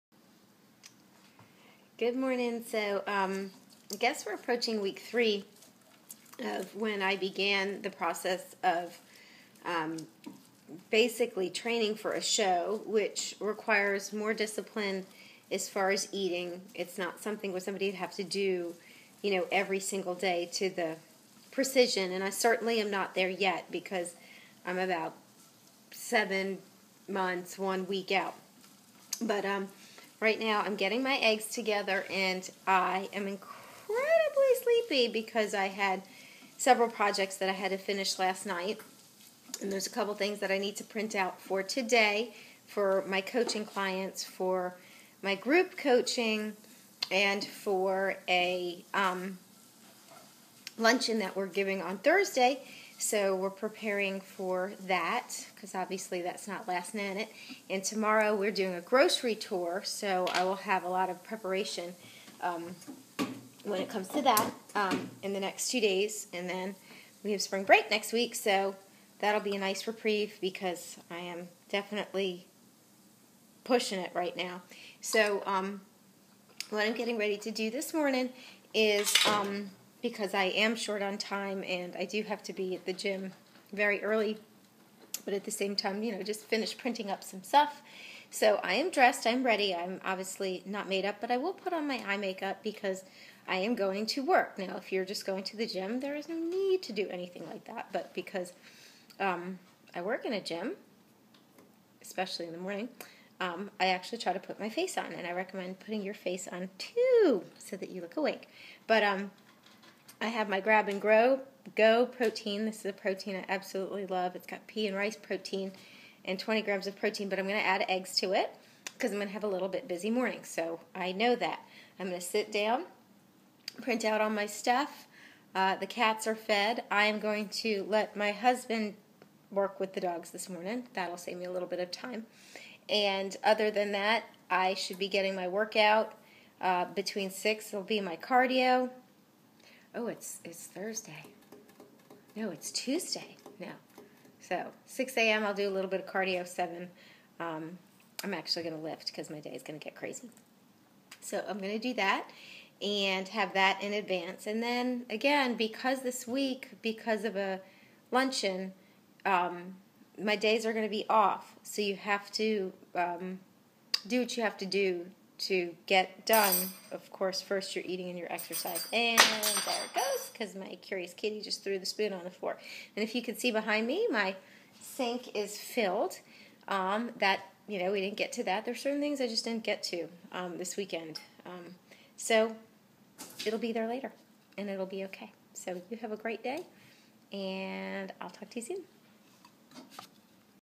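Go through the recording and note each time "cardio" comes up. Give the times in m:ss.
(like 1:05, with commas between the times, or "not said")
2:18, 2:26.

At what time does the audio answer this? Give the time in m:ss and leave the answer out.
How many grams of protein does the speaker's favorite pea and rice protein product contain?
1:56.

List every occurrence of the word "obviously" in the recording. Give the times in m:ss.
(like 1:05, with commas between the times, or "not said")
0:55, 1:30.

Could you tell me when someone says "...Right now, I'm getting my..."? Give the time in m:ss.
0:30.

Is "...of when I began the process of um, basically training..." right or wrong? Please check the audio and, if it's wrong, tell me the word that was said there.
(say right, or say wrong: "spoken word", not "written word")
right.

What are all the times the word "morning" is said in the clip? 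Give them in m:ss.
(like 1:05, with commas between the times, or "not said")
0:02, 1:17, 1:42, 2:00, 2:10.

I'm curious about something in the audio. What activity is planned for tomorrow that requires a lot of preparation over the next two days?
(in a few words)
grocery tour.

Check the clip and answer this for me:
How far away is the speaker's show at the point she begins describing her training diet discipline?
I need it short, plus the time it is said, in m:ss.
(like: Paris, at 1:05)
7 months, 1 week, at 0:25.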